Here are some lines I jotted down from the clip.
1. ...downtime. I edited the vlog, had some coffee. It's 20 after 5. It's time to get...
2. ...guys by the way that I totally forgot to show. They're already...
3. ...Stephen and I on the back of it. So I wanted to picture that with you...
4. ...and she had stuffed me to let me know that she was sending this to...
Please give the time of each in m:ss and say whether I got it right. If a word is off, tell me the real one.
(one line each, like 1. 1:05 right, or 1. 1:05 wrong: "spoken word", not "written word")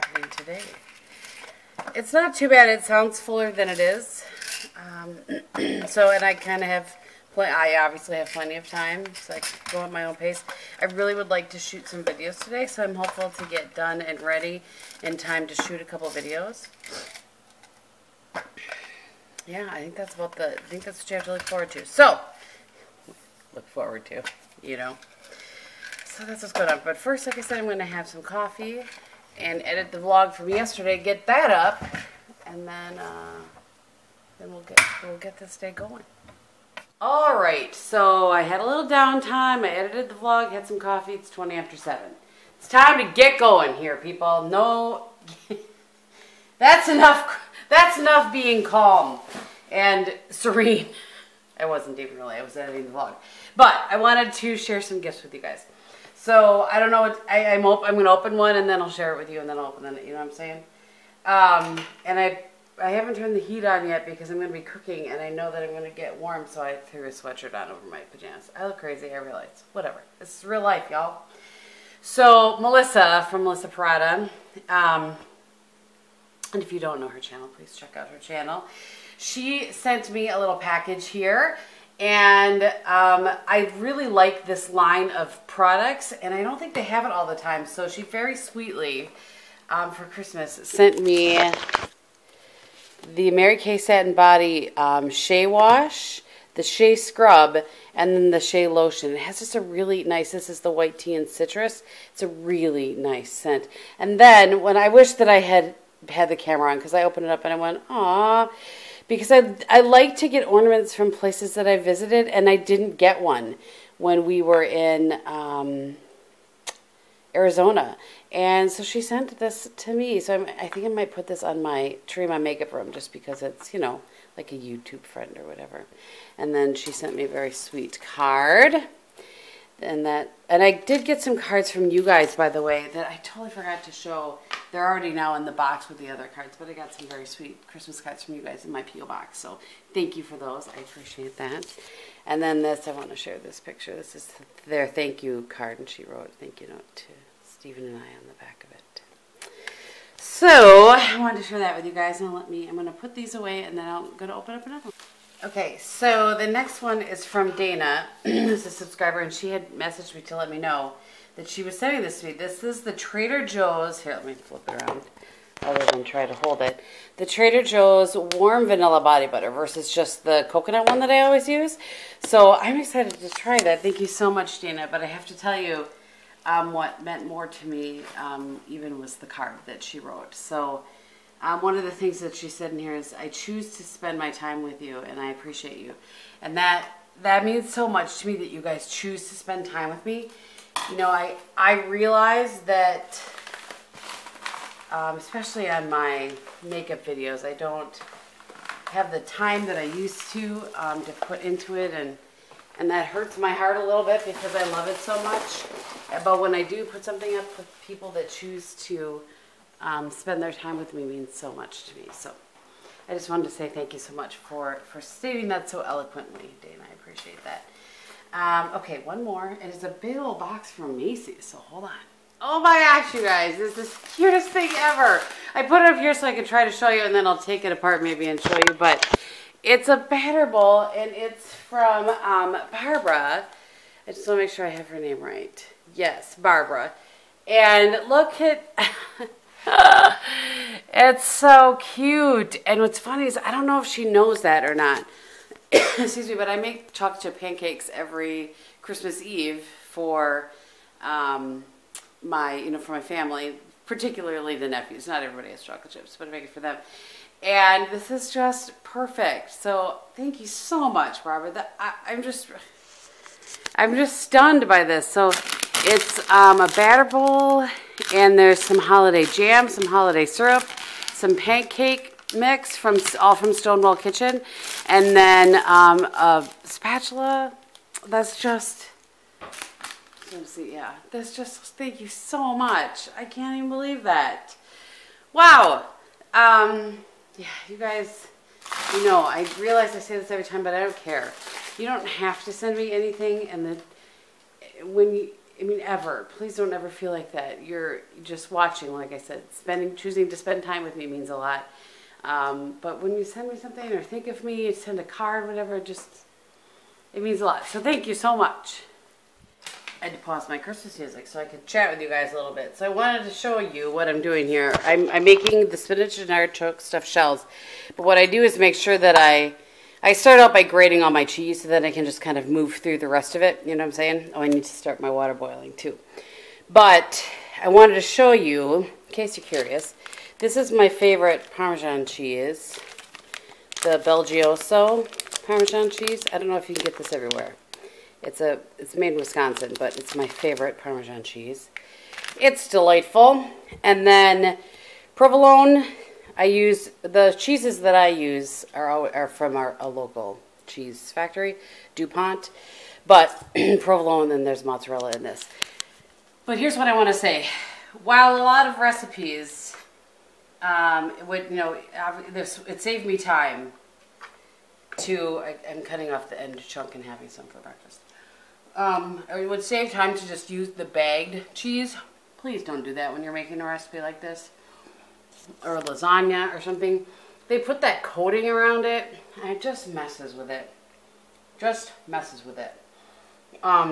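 1. 0:38 wrong: "7", not "5"
2. 2:12 right
3. 2:27 wrong: "share", not "picture"
4. 2:39 wrong: "messaged", not "stuffed".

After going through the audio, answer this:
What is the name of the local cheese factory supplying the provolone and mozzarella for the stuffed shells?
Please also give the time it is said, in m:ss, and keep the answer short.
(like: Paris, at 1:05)
DuPont, at 5:51.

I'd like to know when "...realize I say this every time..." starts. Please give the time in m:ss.
4:49.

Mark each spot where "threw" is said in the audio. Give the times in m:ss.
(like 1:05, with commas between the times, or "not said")
1:06.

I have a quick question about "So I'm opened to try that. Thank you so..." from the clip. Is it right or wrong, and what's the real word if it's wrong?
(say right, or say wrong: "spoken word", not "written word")
wrong: "excited", not "opened".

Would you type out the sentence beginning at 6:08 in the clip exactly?
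Um, it would save time to just use the bagged cheese.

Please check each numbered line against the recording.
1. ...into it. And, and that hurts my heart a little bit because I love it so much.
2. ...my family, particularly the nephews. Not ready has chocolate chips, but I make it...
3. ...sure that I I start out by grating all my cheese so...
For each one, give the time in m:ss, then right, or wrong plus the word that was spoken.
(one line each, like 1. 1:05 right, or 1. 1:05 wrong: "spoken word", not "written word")
1. 3:21 right
2. 4:12 wrong: "everybody", not "ready"
3. 5:18 right.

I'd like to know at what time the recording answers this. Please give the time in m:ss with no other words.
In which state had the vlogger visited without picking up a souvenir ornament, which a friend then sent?
1:57.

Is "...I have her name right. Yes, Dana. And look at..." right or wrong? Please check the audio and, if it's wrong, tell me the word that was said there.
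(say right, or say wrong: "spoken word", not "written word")
wrong: "Barbara", not "Dana".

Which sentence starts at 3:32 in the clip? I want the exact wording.
So I just wanted to say thank you so much for, for stating that so eloquently, Dana.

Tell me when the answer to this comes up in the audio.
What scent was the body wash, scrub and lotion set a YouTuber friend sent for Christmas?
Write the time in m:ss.
1:40.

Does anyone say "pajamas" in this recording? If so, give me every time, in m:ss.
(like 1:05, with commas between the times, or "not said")
1:08.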